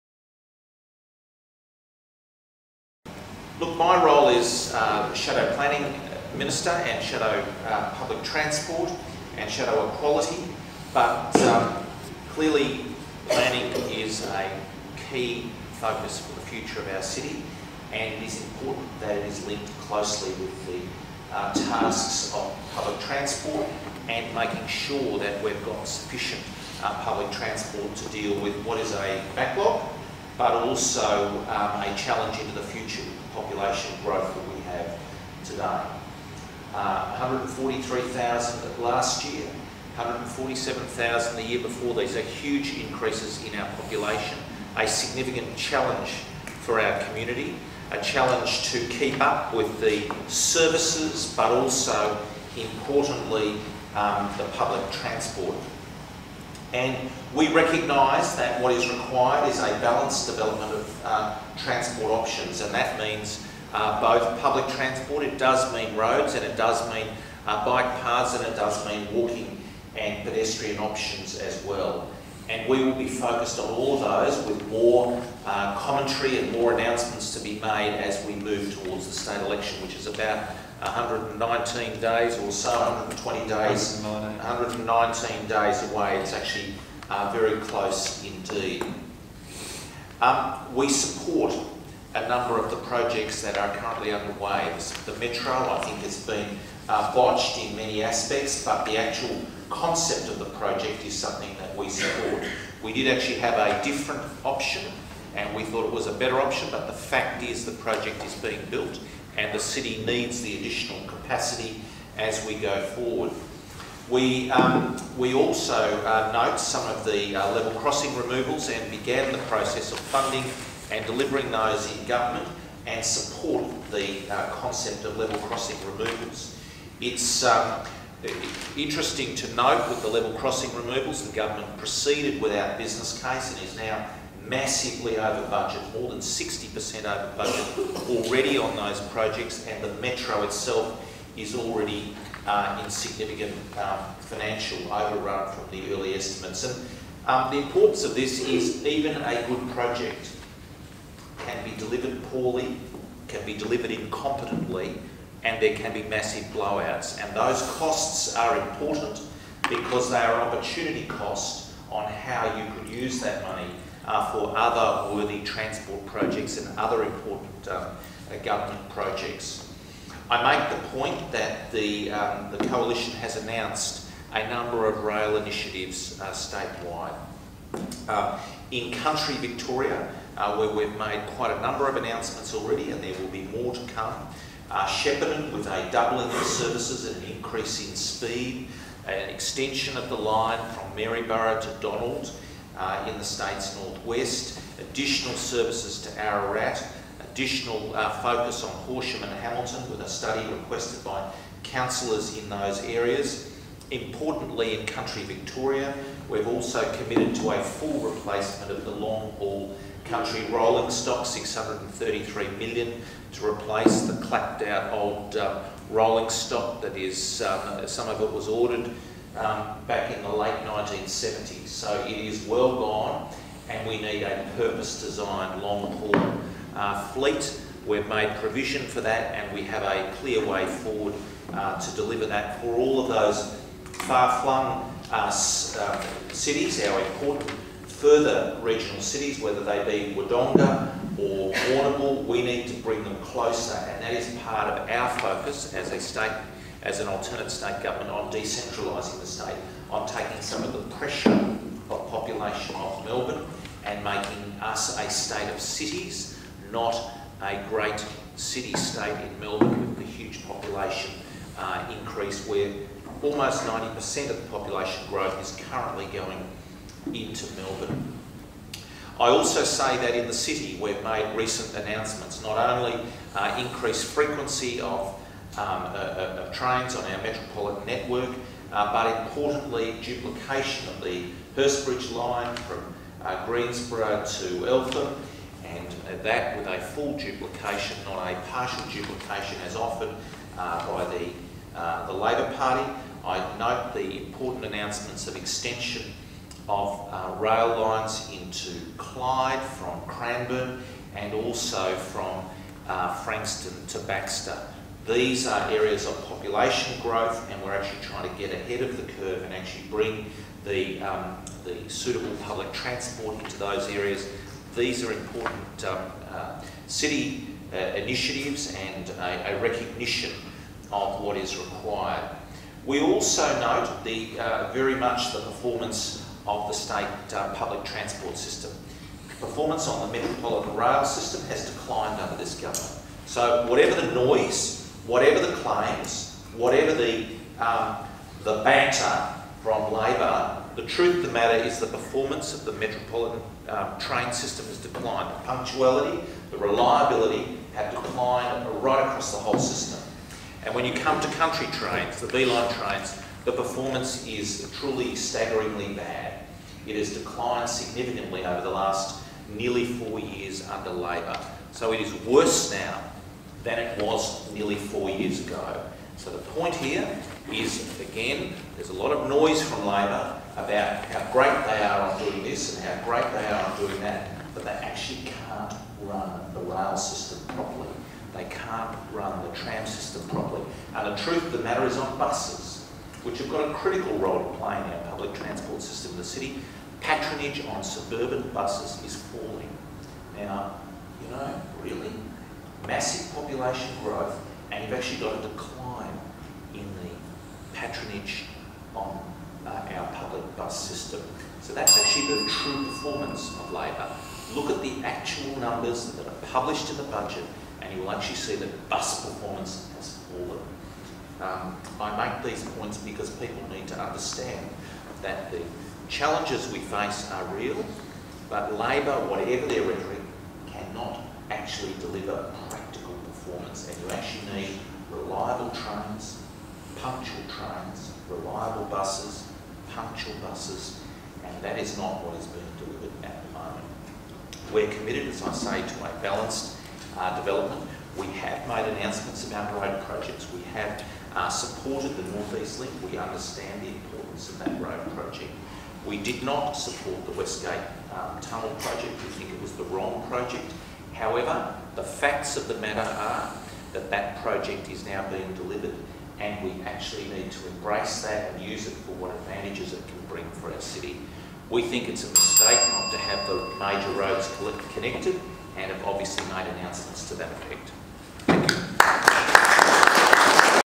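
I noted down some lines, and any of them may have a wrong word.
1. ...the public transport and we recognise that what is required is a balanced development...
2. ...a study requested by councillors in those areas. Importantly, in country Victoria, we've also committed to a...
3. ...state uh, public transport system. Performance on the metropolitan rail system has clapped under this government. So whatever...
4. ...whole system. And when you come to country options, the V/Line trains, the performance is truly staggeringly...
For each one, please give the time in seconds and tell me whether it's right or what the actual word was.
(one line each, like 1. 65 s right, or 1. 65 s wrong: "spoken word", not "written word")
1. 54 s right
2. 200 s right
3. 326 s wrong: "declined", not "clapped"
4. 349 s wrong: "trains", not "options".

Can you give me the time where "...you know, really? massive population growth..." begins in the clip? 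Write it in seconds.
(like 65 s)
391 s.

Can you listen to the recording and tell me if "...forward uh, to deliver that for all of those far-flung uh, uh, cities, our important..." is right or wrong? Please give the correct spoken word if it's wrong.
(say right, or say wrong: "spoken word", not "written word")
right.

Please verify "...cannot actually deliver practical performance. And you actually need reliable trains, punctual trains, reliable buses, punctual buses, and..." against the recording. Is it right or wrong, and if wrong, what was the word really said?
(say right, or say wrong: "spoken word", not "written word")
right.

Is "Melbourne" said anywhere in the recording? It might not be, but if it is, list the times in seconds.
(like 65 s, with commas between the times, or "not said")
253 s, 259 s, 267 s.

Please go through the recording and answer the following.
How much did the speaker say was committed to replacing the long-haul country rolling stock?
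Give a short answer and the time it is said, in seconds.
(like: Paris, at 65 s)
633 million, at 211 s.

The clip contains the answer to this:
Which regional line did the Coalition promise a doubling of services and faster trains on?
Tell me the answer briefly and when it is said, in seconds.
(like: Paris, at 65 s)
Shepparton, at 184 s.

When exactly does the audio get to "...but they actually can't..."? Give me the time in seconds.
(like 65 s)
374 s.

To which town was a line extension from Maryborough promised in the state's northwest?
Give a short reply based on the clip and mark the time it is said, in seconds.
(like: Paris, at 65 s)
Donald, at 191 s.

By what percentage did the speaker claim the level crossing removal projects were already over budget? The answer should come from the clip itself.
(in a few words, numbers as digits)
More than 60%.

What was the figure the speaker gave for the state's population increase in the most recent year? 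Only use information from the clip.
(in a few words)
143,000.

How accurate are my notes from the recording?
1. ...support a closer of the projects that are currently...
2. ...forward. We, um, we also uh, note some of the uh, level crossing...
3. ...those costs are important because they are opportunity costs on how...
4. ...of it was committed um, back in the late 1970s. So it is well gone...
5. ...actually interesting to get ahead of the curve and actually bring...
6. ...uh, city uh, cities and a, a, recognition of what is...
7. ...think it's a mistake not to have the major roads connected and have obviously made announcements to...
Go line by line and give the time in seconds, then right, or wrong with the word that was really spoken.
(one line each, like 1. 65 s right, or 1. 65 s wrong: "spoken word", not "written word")
1. 90 s wrong: "number", not "closer"
2. 112 s right
3. 157 s right
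4. 218 s wrong: "ordered", not "committed"
5. 307 s wrong: "trying", not "interesting"
6. 316 s wrong: "initiatives", not "cities"
7. 461 s right.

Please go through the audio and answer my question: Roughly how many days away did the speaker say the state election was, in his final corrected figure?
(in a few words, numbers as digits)
119.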